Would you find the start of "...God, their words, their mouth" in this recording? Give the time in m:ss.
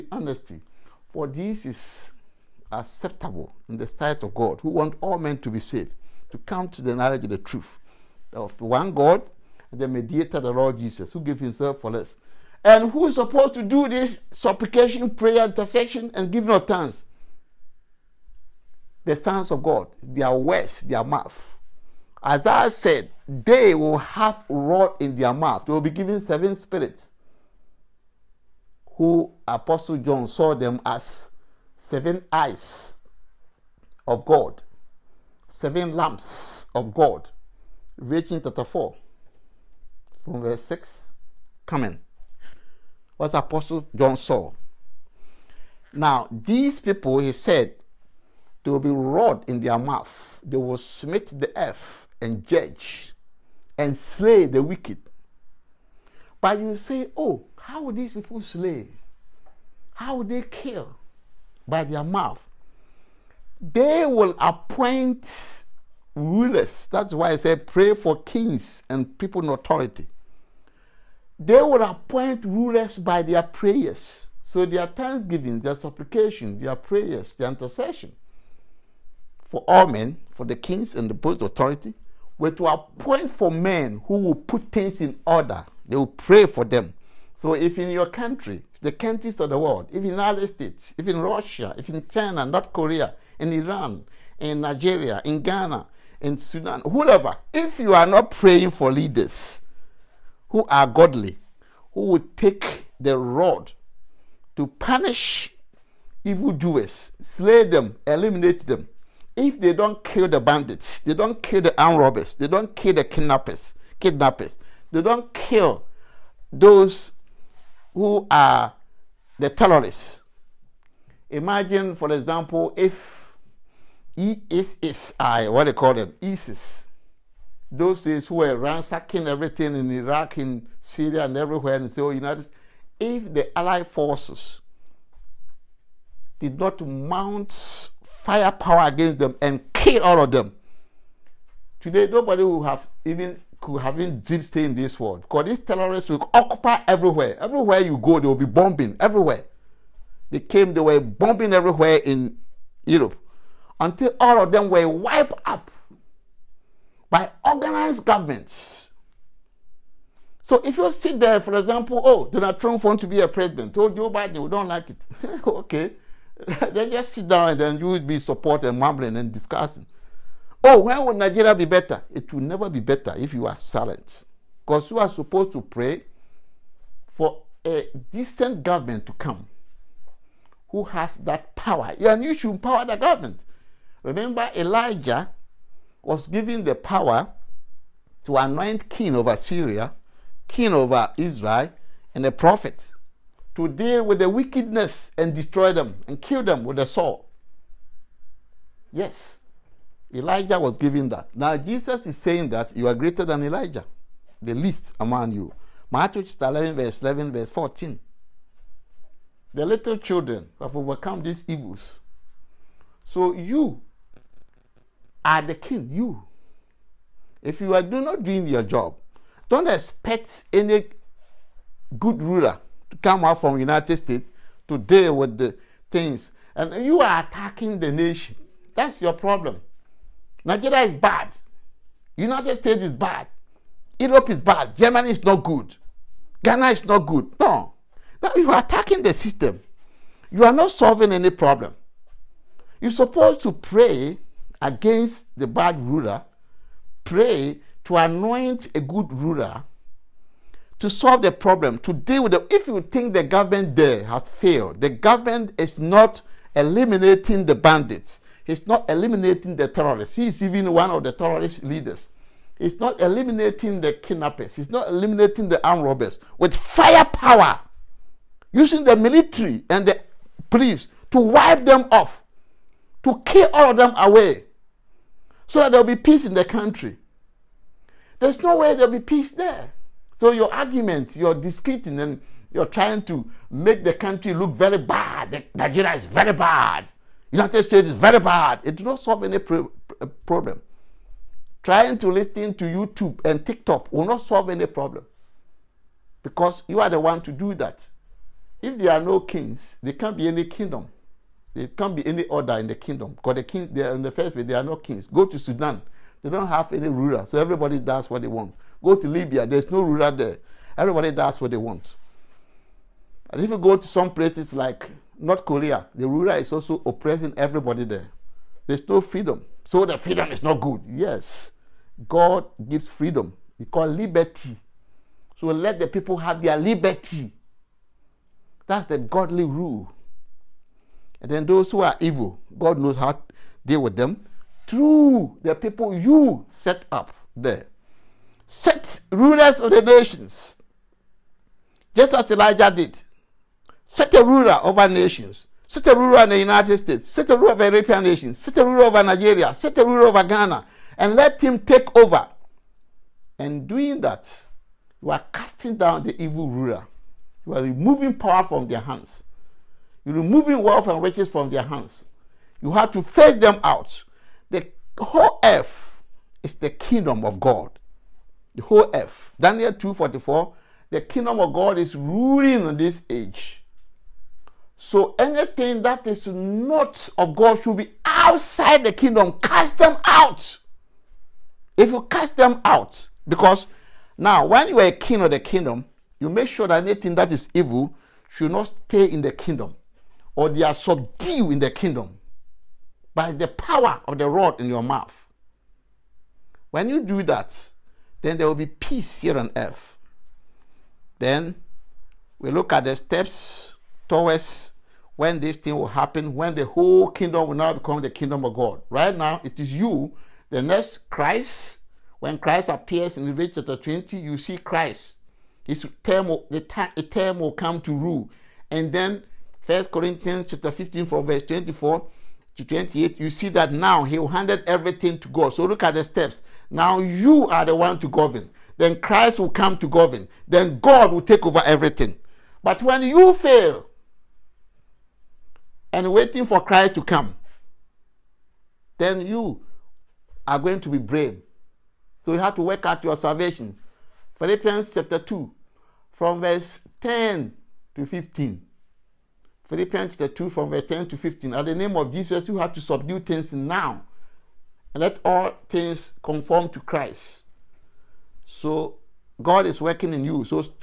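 0:19.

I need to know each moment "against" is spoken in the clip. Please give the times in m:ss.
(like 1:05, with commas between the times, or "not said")
2:18, 4:04.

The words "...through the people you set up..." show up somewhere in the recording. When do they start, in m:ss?
5:34.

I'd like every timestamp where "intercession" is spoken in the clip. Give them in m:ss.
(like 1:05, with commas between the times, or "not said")
0:15, 1:17.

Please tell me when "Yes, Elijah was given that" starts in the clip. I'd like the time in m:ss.
3:18.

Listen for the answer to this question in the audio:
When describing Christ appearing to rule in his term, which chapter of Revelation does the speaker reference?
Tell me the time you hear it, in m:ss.
6:53.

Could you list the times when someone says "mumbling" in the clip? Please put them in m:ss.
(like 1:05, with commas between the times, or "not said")
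2:48.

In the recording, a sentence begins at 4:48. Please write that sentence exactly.
It does not solve any uh, problem.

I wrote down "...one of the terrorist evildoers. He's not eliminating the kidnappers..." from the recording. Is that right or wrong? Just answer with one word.
wrong.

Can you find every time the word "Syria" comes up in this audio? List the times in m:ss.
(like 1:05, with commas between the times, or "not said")
2:10, 3:09.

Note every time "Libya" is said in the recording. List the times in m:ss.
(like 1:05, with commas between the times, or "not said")
5:09.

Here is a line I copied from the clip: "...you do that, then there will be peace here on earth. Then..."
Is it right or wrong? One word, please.
right.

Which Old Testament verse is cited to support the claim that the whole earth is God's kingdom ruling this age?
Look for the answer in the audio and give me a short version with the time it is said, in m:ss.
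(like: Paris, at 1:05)
Daniel 2:44, at 6:09.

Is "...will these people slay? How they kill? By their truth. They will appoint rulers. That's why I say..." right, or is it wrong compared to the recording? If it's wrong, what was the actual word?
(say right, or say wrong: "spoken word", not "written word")
wrong: "mouth", not "truth".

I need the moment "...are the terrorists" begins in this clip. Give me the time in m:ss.
1:58.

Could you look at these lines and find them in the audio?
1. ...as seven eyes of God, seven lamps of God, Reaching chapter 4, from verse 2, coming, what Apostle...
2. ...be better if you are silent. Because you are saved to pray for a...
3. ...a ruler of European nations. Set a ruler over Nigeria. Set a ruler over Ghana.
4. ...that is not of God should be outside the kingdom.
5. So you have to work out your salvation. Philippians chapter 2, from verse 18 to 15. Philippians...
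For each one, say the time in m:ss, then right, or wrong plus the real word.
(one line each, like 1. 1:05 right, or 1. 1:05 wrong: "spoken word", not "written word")
1. 0:30 wrong: "6", not "2"
2. 2:52 wrong: "supposed", not "saved"
3. 5:47 right
4. 6:15 right
5. 7:22 wrong: "10", not "18".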